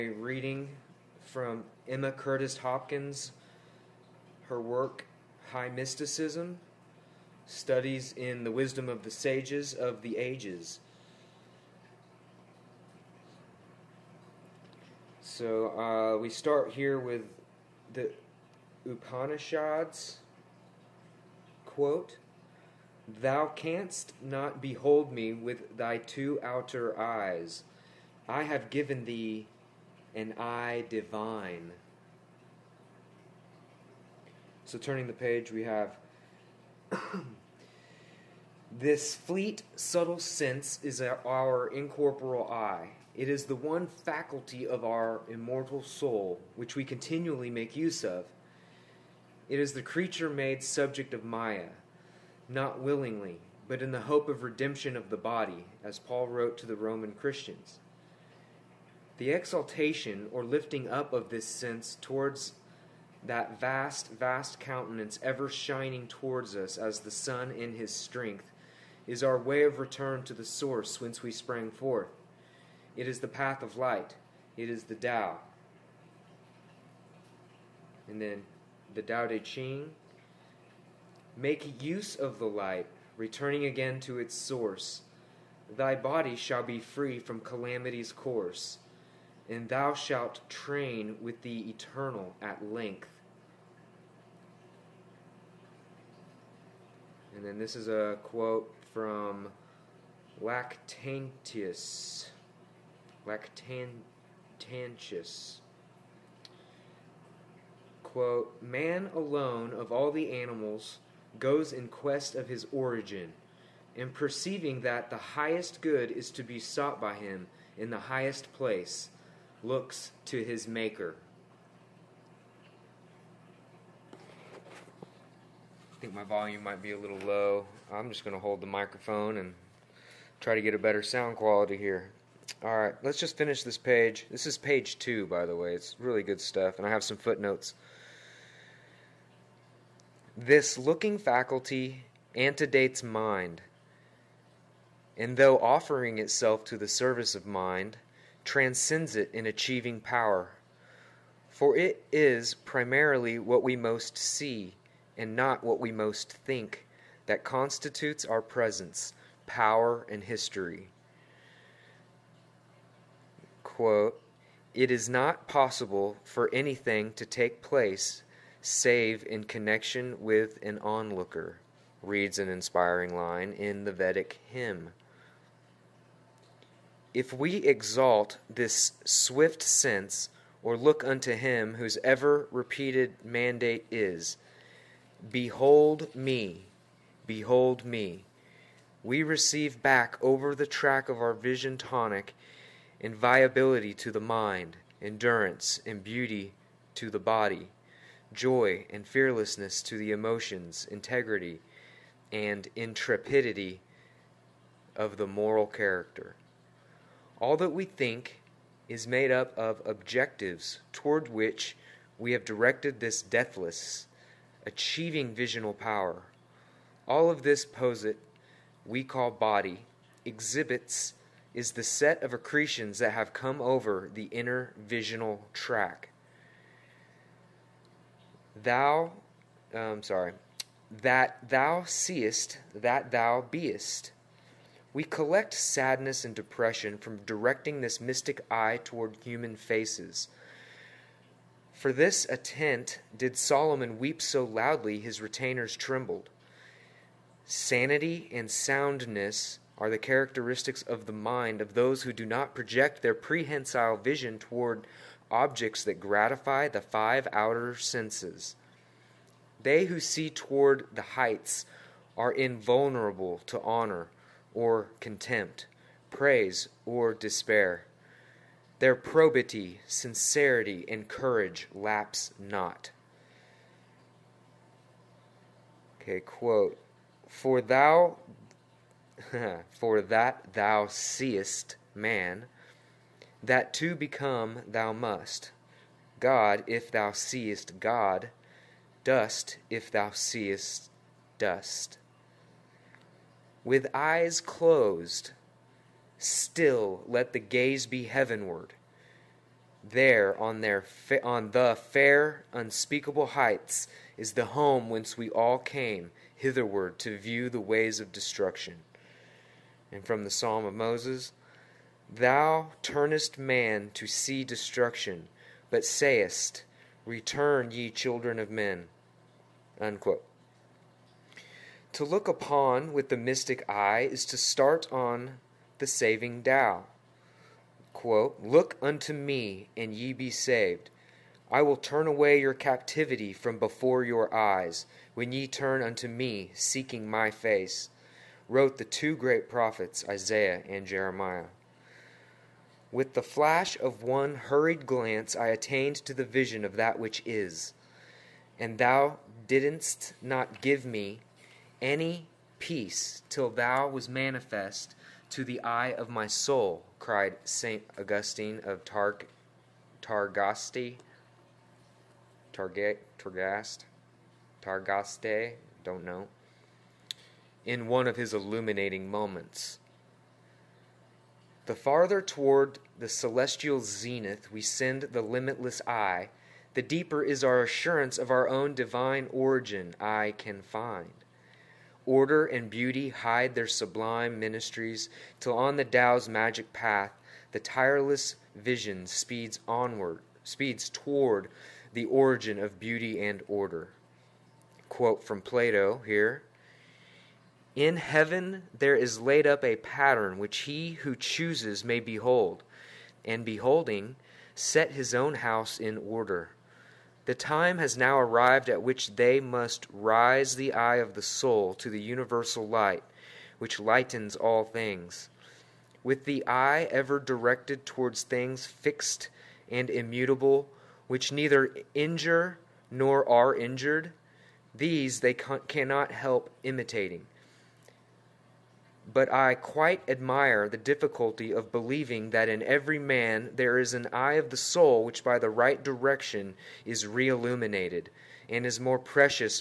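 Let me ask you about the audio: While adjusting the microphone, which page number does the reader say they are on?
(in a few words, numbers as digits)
2.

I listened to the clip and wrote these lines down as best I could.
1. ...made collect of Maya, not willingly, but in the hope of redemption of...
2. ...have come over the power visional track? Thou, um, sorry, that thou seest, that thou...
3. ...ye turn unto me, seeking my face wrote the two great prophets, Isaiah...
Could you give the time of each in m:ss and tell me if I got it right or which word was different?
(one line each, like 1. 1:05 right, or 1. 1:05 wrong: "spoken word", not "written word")
1. 0:50 wrong: "subject", not "collect"
2. 3:43 wrong: "inner", not "power"
3. 5:35 right.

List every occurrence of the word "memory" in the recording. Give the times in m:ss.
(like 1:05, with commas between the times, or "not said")
not said.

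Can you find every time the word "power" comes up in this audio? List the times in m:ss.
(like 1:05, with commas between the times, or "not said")
2:29, 2:39, 3:35.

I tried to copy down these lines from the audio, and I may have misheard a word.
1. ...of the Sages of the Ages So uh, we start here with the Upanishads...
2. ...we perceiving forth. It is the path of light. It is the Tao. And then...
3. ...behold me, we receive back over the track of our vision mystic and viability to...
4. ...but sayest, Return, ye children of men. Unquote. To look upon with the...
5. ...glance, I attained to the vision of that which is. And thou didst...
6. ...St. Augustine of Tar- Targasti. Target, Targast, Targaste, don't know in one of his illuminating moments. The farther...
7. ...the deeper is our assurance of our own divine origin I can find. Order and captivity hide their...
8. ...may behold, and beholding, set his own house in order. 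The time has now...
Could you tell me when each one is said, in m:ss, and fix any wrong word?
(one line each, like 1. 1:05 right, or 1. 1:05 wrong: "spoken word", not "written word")
1. 0:08 right
2. 1:11 wrong: "sprang", not "perceiving"
3. 3:07 wrong: "tonic", not "mystic"
4. 5:15 right
5. 5:44 right
6. 5:57 right
7. 6:16 wrong: "beauty", not "captivity"
8. 6:41 right.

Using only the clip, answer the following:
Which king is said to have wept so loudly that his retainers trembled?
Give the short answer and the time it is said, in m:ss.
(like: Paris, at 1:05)
Solomon, at 4:03.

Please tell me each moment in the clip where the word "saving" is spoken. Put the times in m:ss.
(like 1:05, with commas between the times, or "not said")
5:25.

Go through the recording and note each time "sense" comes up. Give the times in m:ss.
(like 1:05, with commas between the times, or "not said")
0:40, 1:01, 2:59, 4:17.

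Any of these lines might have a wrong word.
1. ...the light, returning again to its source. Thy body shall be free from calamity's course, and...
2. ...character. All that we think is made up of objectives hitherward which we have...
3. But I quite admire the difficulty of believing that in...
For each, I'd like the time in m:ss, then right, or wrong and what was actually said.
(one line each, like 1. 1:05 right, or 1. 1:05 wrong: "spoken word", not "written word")
1. 1:22 right
2. 3:25 wrong: "toward", not "hitherward"
3. 7:09 right.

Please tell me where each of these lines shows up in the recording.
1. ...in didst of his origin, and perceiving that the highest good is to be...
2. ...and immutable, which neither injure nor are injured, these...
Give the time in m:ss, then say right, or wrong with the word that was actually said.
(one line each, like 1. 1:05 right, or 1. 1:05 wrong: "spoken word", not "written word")
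1. 1:51 wrong: "quest", not "didst"
2. 6:59 right.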